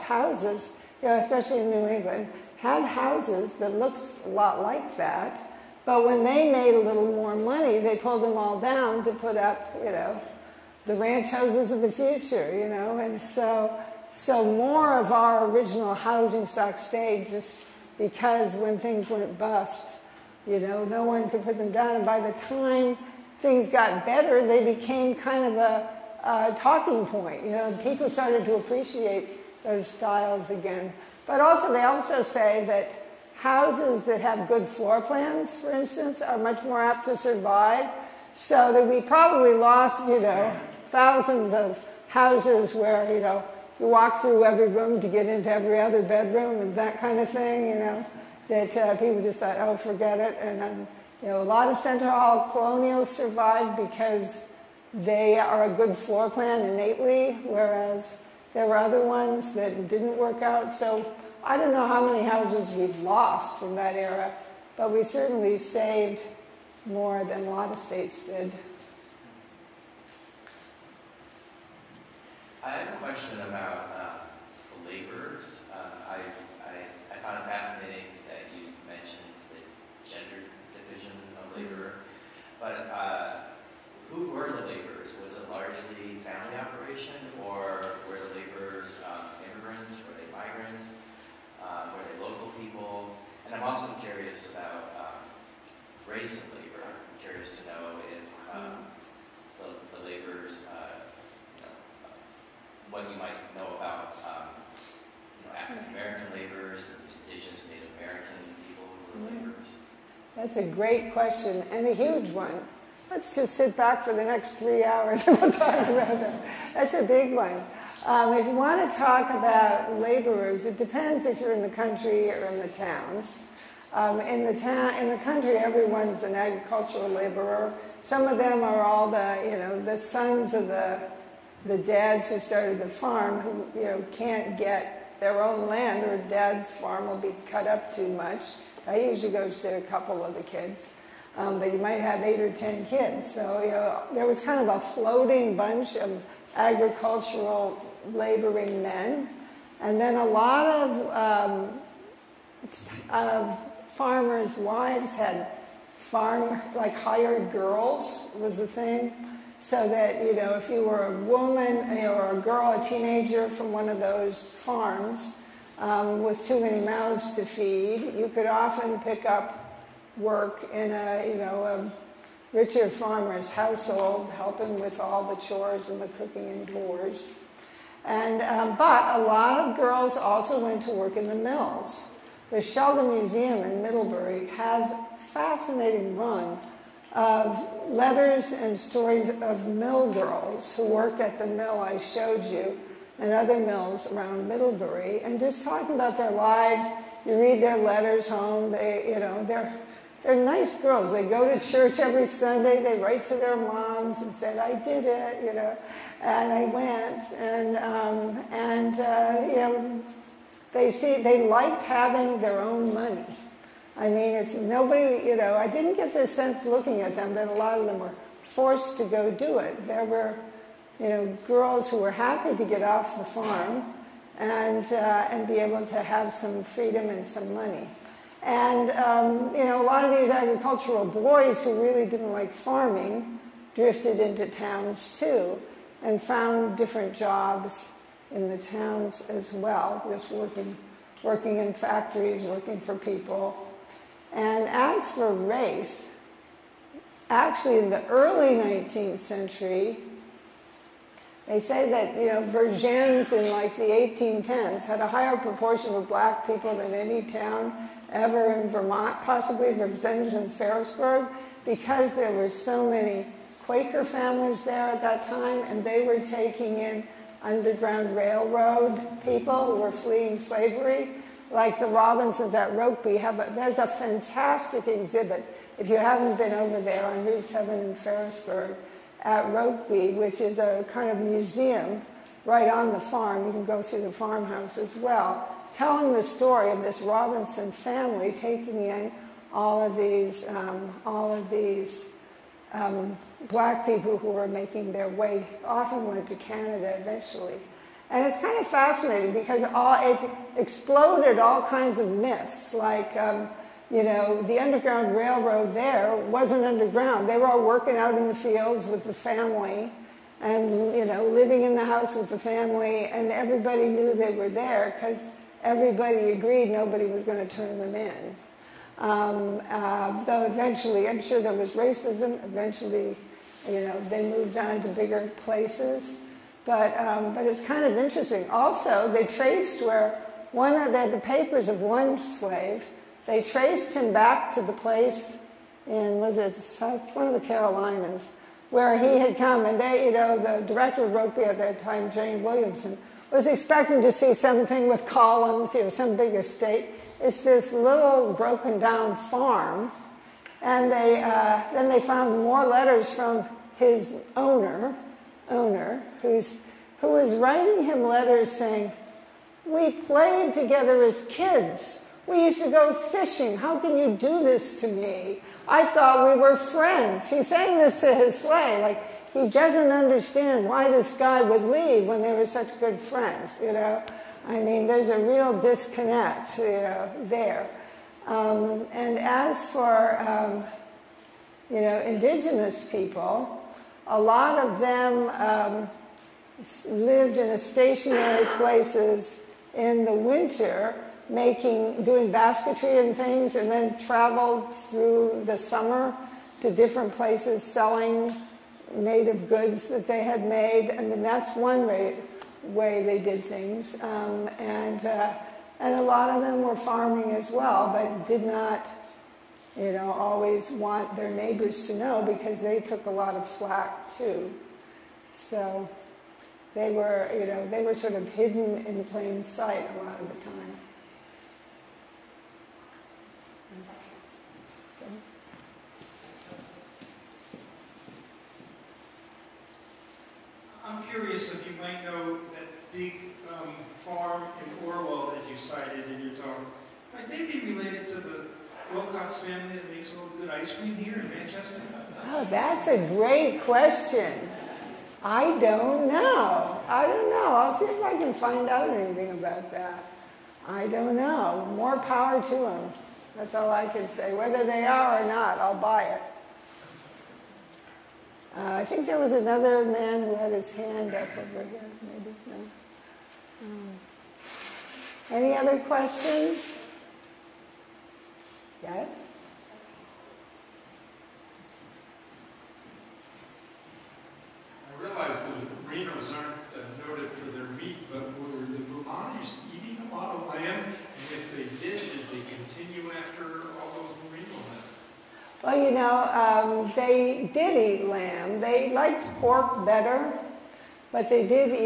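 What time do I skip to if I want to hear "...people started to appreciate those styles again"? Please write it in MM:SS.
00:27.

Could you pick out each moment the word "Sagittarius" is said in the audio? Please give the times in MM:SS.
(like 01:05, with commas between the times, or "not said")
not said.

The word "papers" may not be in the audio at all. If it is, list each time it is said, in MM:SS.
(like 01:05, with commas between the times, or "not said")
05:31.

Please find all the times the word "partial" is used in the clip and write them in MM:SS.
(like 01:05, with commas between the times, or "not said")
not said.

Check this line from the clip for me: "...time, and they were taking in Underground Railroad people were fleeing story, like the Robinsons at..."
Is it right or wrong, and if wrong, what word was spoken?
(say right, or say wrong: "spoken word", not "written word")
wrong: "slavery", not "story".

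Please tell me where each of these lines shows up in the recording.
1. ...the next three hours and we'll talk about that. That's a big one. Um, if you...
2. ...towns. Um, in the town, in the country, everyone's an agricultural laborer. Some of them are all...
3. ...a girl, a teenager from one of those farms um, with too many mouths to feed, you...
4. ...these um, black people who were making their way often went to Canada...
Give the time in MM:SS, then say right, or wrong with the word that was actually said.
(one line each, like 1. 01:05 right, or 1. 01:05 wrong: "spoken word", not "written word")
1. 01:54 right
2. 02:02 right
3. 02:42 right
4. 04:51 right.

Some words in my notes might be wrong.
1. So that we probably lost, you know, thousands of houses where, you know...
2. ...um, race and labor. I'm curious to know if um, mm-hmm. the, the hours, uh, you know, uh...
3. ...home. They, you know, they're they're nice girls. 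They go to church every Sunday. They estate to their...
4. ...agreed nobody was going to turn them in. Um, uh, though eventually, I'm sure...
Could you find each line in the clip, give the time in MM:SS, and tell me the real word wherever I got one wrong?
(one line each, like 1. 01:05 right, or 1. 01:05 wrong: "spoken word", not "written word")
1. 00:38 right
2. 01:34 wrong: "laborers", not "hours"
3. 03:18 wrong: "write", not "estate"
4. 05:16 right.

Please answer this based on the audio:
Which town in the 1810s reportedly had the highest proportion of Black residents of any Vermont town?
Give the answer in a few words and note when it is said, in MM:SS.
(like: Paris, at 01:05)
Vergennes, at 04:12.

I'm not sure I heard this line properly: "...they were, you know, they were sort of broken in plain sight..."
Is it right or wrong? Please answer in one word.
wrong.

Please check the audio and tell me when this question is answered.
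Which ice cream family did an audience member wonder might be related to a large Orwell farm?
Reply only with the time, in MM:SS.
07:18.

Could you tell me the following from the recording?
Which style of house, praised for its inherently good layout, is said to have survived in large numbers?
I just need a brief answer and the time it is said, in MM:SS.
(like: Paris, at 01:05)
Center Hall colonials, at 00:51.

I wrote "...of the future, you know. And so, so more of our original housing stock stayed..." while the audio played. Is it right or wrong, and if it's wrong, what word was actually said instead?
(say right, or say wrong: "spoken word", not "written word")
right.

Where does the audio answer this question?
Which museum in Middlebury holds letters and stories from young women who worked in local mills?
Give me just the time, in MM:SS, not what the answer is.
03:02.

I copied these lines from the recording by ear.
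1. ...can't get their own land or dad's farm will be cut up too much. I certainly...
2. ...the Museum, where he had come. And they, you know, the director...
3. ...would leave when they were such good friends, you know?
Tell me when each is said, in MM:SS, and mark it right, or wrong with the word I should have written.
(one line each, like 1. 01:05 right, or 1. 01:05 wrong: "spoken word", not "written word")
1. 02:14 wrong: "usually", not "certainly"
2. 05:37 wrong: "Carolinas", not "Museum"
3. 06:11 right.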